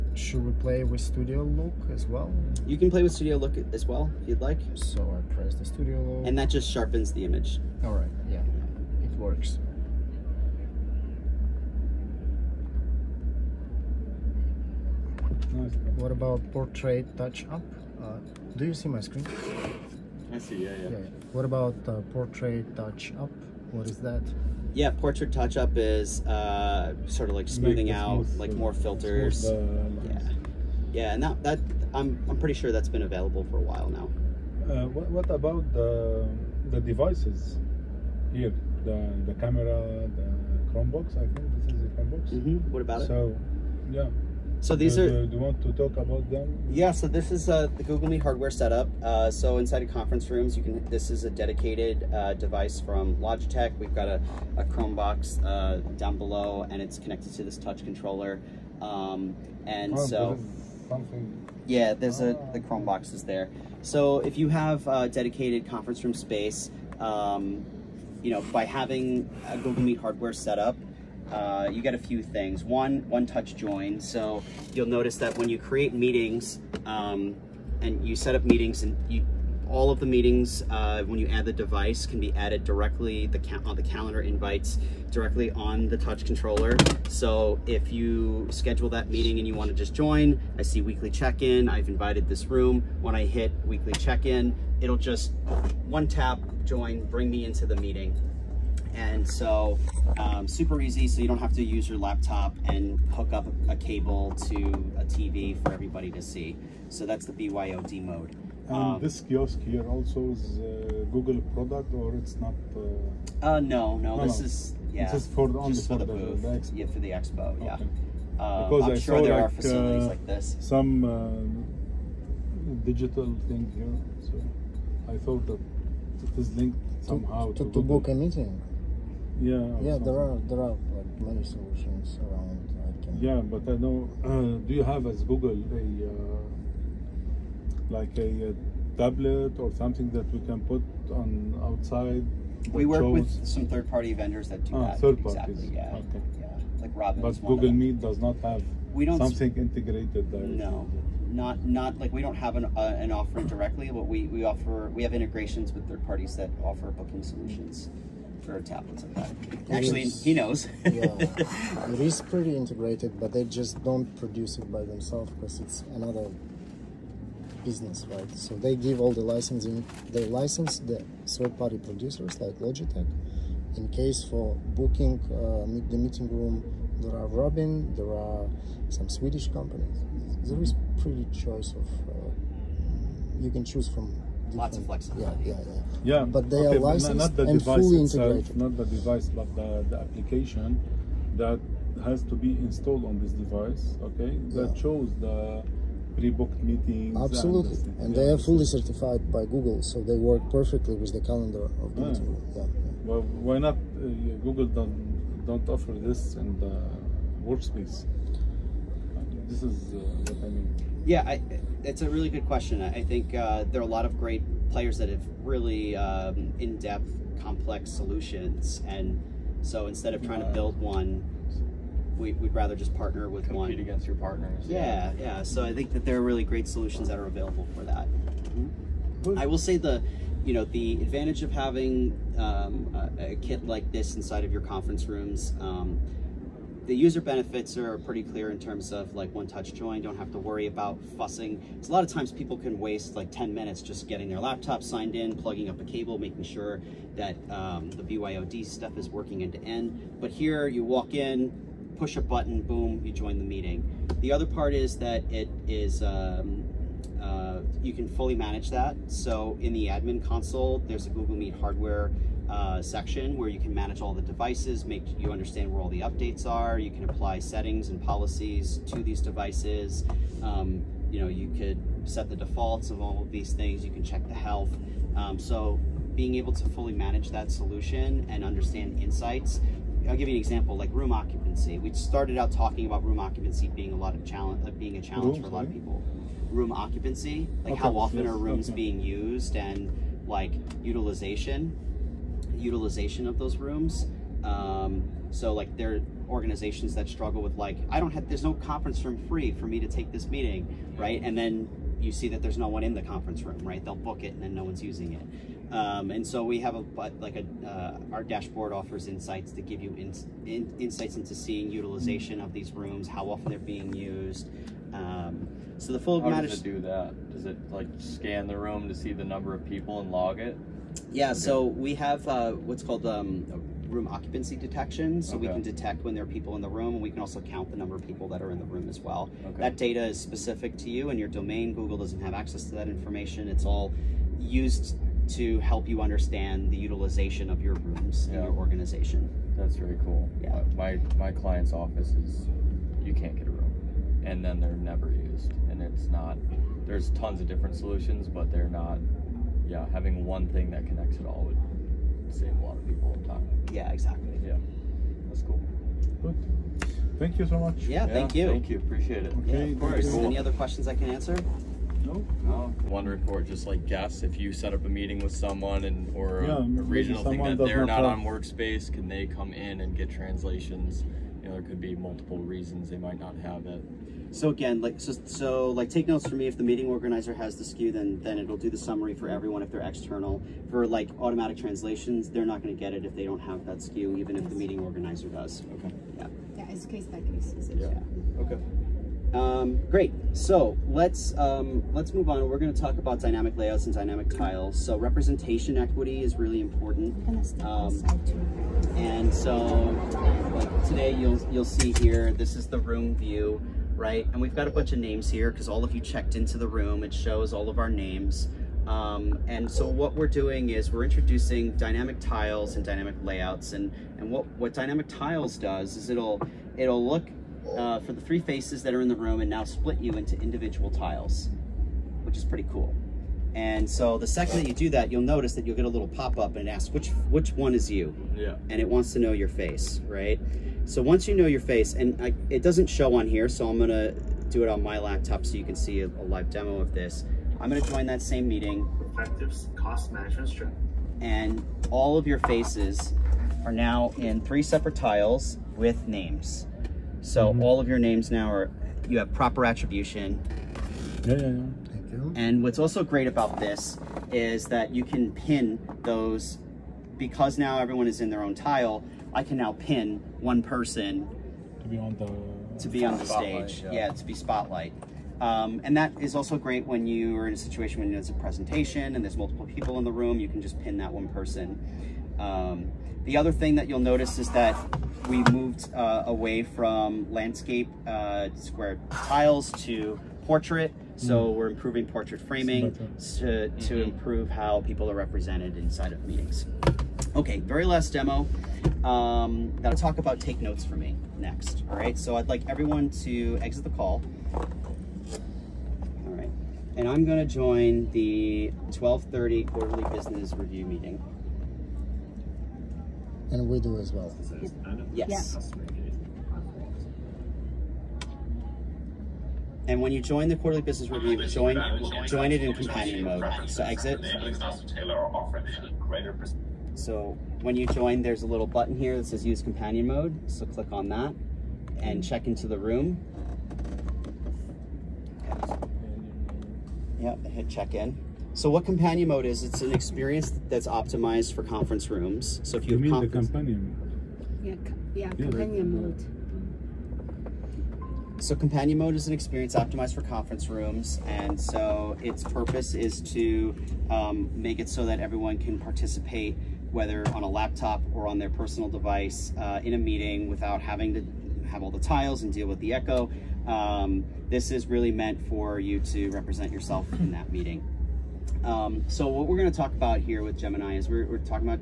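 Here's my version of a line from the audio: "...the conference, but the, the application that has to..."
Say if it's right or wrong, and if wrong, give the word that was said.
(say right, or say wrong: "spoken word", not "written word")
wrong: "device", not "conference".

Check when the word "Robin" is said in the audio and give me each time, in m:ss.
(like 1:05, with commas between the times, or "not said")
2:26, 2:57.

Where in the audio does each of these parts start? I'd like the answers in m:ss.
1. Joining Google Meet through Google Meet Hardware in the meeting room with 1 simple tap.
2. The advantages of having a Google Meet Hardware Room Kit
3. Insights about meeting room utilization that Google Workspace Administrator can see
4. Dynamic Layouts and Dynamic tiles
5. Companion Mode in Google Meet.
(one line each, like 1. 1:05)
1. 1:05
2. 3:49
3. 4:36
4. 6:26
5. 8:07.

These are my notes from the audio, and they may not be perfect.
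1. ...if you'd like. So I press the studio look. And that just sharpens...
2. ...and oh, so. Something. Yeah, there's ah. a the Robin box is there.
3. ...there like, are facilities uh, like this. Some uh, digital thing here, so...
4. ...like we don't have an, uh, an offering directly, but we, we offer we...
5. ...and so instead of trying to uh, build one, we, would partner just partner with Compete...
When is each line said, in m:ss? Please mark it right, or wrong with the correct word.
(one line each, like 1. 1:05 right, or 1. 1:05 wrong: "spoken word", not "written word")
1. 0:04 right
2. 0:59 wrong: "Chrome", not "Robin"
3. 1:59 right
4. 2:31 right
5. 3:38 wrong: "rather", not "partner".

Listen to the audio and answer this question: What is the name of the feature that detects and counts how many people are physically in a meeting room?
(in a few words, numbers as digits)
Room occupancy detection.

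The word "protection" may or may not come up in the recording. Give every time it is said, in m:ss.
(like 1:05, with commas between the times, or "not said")
not said.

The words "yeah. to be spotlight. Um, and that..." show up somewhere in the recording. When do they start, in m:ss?
7:44.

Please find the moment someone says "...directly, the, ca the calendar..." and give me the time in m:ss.
1:22.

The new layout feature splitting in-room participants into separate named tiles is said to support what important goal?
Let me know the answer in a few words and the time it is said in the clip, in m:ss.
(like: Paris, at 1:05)
Representation equity, at 6:34.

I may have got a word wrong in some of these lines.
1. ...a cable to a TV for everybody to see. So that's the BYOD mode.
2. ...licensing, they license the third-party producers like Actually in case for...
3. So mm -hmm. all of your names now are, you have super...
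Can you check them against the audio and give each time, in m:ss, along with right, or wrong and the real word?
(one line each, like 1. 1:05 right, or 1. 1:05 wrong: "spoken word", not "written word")
1. 1:43 right
2. 2:49 wrong: "Logitech", not "Actually"
3. 7:27 wrong: "proper", not "super".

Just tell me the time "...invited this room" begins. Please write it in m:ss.
1:31.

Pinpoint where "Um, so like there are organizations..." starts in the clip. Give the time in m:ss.
4:54.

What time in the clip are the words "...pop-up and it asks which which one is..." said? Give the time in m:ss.
7:06.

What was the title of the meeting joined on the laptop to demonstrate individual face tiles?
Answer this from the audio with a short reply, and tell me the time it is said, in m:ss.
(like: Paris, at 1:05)
Effective cost management strategy, at 7:19.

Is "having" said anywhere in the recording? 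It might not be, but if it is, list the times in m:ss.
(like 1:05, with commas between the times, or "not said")
1:08, 3:51, 5:49, 9:10.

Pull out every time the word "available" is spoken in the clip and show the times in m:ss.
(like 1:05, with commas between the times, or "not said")
0:33, 3:47.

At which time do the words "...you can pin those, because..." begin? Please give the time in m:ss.
7:34.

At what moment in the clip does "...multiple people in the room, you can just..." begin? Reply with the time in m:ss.
7:49.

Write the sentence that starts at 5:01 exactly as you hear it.
And then you see that there's no one in the conference room, right?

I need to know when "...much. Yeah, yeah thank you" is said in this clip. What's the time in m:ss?
5:57.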